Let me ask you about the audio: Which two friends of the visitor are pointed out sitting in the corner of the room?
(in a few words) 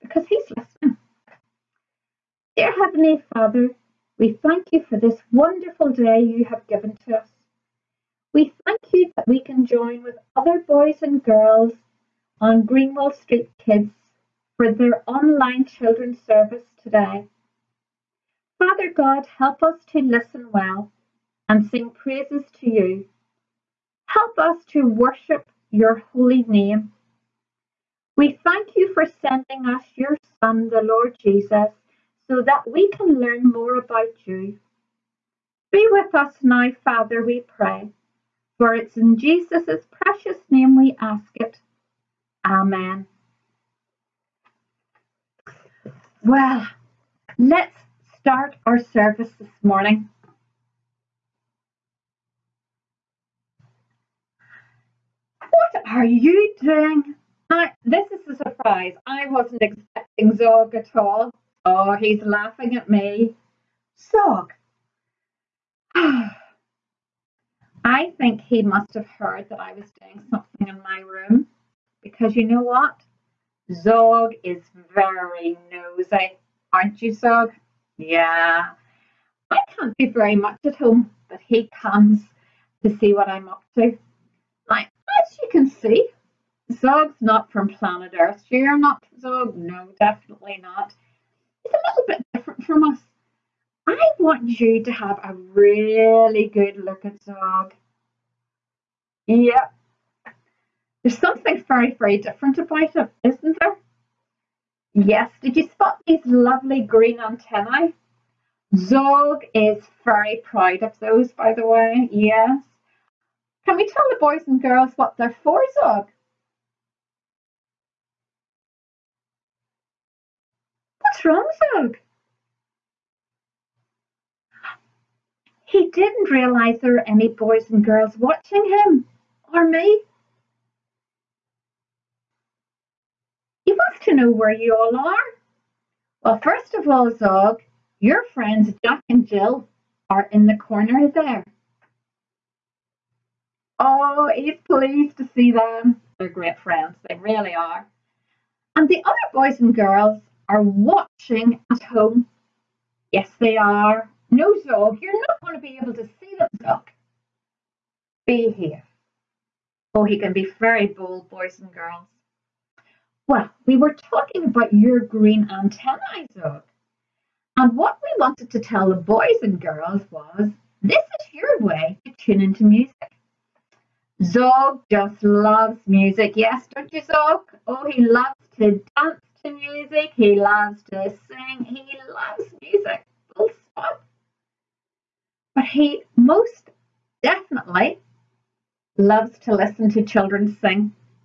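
Jack and Jill.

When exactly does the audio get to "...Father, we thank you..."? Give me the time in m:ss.
0:03.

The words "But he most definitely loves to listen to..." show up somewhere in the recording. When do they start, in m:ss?
3:05.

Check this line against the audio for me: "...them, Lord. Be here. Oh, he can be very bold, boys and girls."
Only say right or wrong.
wrong.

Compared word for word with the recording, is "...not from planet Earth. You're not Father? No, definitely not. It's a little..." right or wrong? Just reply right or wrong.
wrong.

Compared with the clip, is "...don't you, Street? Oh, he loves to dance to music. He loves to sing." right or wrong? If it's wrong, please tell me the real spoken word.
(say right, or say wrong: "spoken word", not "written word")
wrong: "Zog", not "Street".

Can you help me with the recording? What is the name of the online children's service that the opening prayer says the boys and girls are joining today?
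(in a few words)
Greenwell Street Kids.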